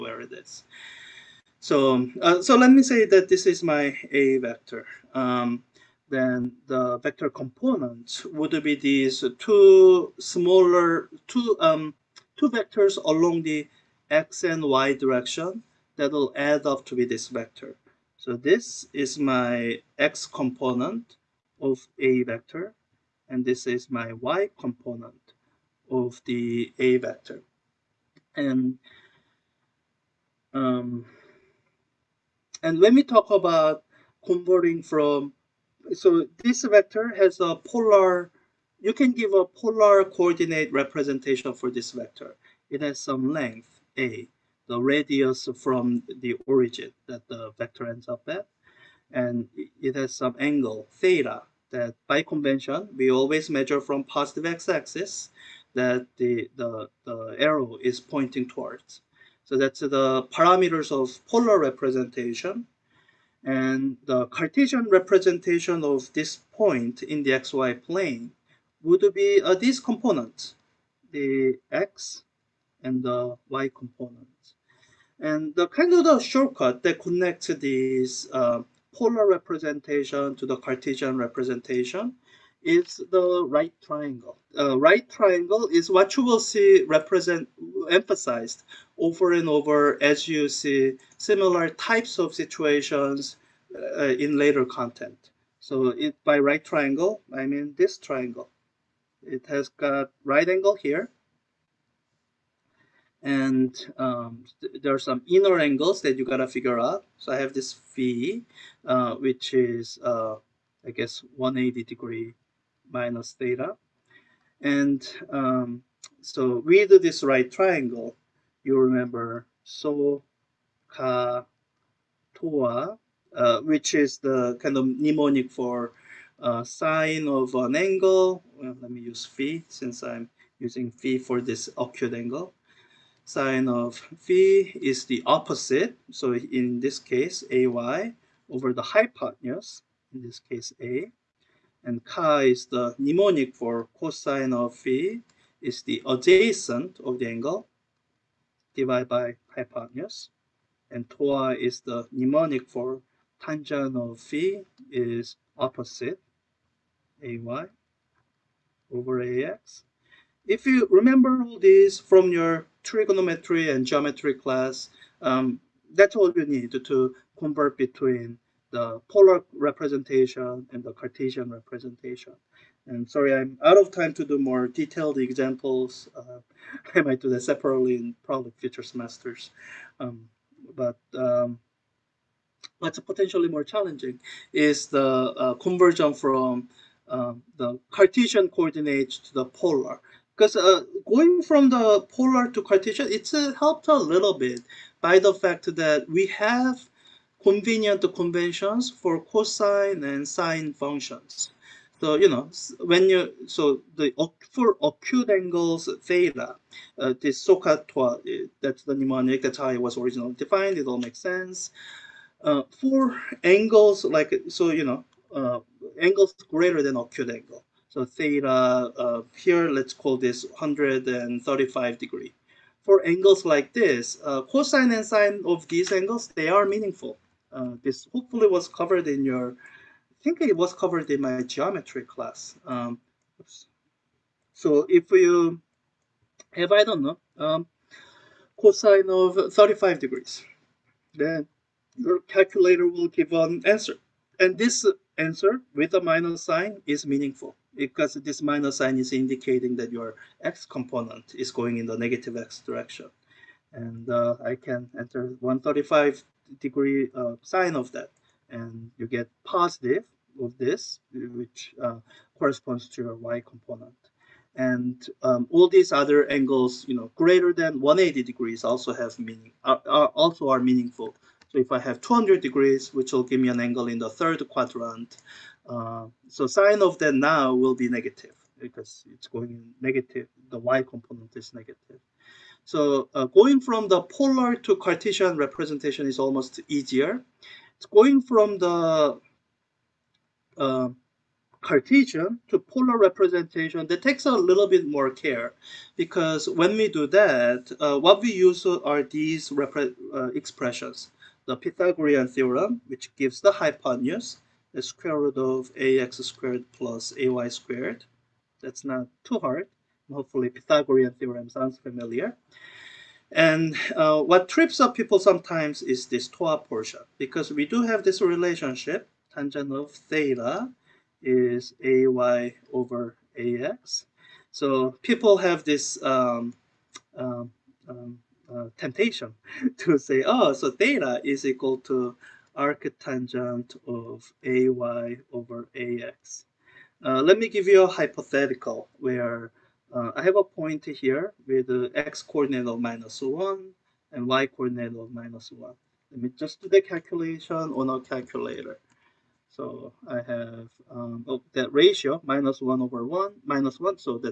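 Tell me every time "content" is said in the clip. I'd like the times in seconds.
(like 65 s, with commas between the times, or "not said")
94 s.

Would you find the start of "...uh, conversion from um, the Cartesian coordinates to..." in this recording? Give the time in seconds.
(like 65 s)
185 s.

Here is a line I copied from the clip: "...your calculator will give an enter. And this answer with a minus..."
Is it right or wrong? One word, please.
wrong.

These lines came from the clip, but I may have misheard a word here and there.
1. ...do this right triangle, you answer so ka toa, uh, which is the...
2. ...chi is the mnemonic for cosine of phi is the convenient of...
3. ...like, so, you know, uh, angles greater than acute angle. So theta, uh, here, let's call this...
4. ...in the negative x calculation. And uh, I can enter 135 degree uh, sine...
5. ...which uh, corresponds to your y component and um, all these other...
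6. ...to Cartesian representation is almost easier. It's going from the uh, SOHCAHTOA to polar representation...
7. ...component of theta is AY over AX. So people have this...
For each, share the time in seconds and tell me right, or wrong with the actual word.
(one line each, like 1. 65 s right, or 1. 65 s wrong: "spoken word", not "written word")
1. 116 s wrong: "remember", not "answer"
2. 142 s wrong: "adjacent", not "convenient"
3. 214 s right
4. 251 s wrong: "direction", not "calculation"
5. 261 s right
6. 284 s wrong: "Cartesian", not "SOHCAHTOA"
7. 319 s wrong: "tangent", not "component".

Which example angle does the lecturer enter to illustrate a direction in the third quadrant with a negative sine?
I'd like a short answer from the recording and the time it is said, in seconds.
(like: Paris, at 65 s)
200 degrees, at 272 s.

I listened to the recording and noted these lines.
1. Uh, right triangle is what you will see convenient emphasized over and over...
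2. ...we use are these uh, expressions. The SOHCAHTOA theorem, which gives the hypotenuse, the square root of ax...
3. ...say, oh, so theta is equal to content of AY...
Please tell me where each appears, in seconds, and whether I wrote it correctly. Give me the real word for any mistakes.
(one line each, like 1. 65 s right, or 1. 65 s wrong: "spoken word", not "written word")
1. 84 s wrong: "represent", not "convenient"
2. 298 s wrong: "Pythagorean", not "SOHCAHTOA"
3. 329 s wrong: "arctangent", not "content".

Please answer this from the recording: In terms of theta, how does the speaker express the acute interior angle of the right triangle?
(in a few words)
180 degrees minus theta.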